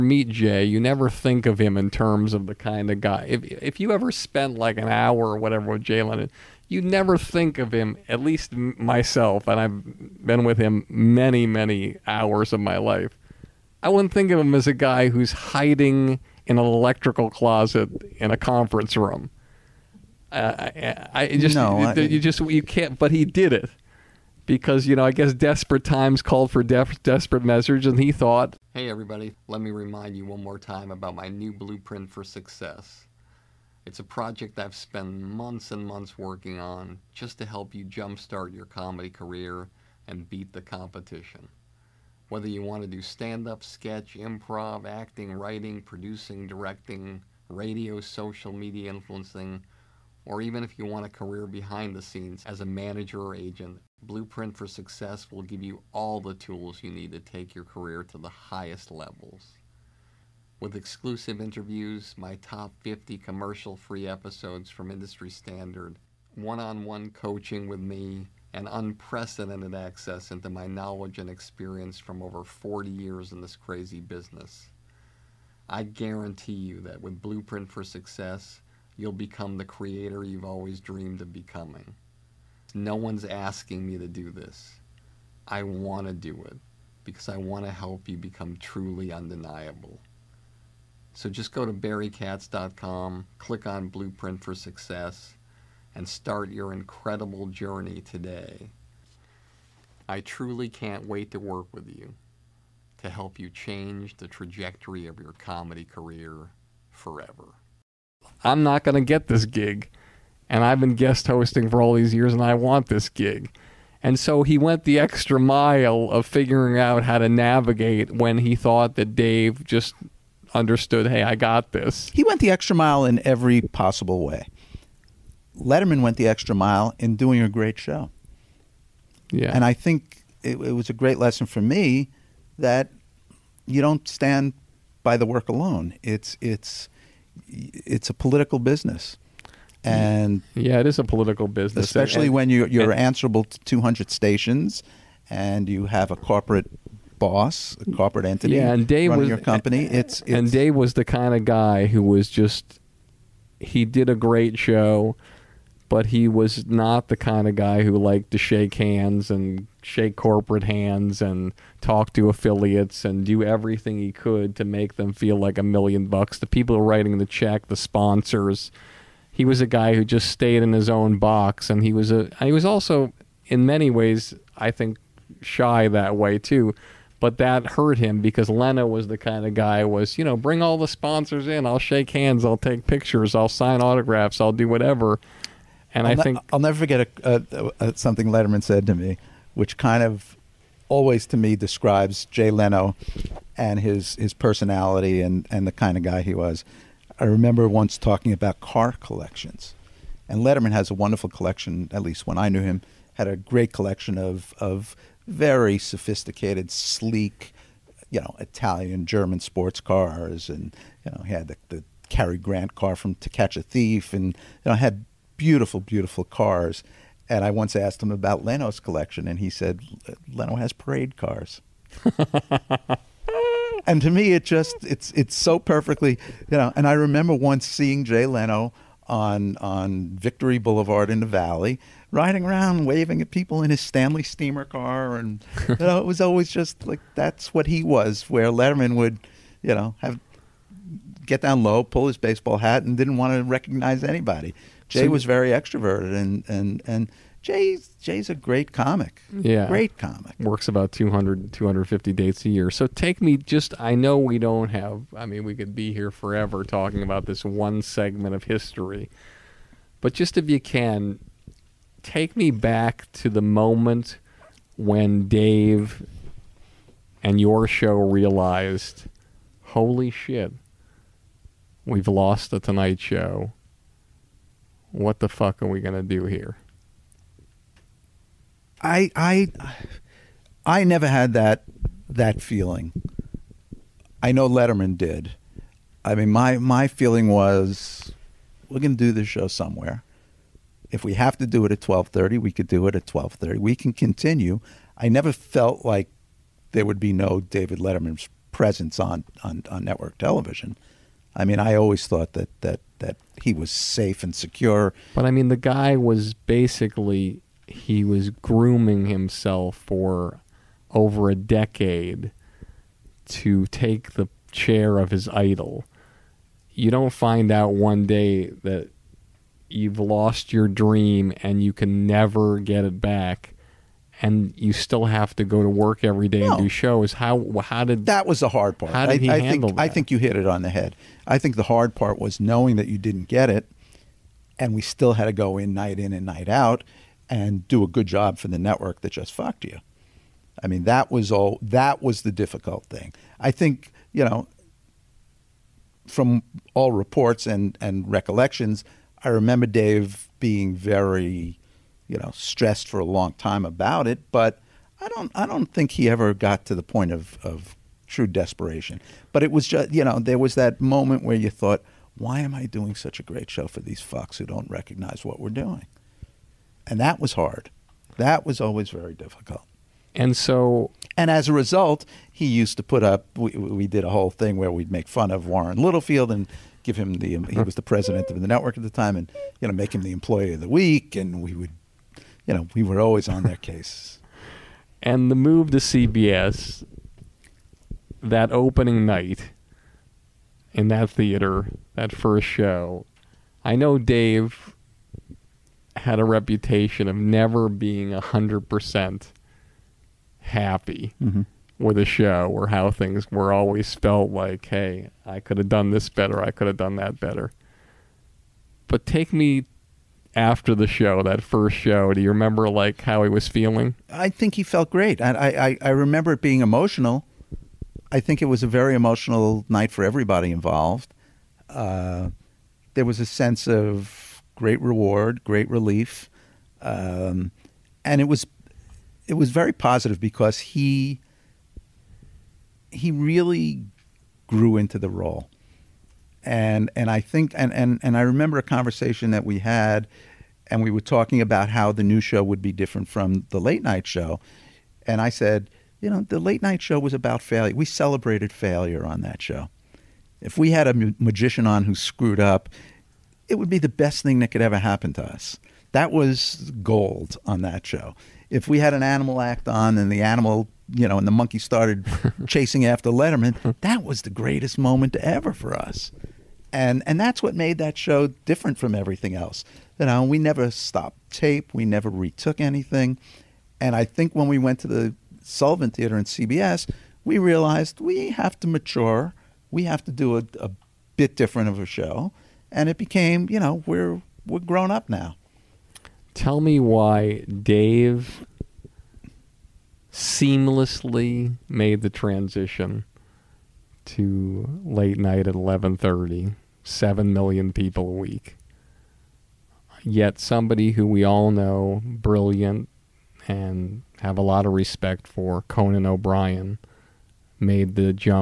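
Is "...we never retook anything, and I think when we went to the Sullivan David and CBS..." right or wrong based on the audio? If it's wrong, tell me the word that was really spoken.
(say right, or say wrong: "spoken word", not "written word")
wrong: "Theater", not "David".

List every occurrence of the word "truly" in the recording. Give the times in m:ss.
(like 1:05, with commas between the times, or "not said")
1:28, 1:40.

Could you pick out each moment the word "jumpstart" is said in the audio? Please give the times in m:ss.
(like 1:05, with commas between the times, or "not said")
0:37.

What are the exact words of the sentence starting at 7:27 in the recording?
We celebrated failure on that show.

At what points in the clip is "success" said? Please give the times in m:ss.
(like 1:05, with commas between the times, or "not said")
0:32, 0:54, 1:17, 1:34.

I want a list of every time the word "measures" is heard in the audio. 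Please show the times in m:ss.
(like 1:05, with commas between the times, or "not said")
0:27.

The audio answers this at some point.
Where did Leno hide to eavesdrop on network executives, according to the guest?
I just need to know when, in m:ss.
0:16.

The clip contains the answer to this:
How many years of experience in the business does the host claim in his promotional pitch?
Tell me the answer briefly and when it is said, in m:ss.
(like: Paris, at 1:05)
40, at 1:12.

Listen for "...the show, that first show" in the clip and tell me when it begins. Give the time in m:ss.
6:50.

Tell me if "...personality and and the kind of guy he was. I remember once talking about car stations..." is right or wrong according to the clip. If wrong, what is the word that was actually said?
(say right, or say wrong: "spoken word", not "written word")
wrong: "collections", not "stations".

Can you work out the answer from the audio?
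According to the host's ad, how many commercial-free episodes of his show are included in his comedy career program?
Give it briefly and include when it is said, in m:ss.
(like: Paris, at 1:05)
50, at 1:02.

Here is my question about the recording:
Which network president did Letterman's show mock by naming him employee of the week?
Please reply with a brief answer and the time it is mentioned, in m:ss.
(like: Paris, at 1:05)
Warren Littlefield, at 6:15.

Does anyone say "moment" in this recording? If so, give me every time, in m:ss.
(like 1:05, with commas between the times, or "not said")
4:23, 6:00, 7:44.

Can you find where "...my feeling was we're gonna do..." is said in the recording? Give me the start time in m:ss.
4:46.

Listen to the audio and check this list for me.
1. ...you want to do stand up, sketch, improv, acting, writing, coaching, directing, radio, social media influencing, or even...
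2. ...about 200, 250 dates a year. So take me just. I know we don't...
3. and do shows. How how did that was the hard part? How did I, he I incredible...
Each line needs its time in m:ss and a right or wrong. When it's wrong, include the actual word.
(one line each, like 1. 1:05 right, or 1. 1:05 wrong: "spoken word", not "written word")
1. 0:42 wrong: "producing", not "coaching"
2. 4:10 right
3. 5:26 wrong: "handle", not "incredible".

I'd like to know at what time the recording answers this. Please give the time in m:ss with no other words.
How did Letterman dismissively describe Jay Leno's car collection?
3:40.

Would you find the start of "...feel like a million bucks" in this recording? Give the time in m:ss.
2:45.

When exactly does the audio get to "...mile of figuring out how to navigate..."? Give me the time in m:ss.
1:55.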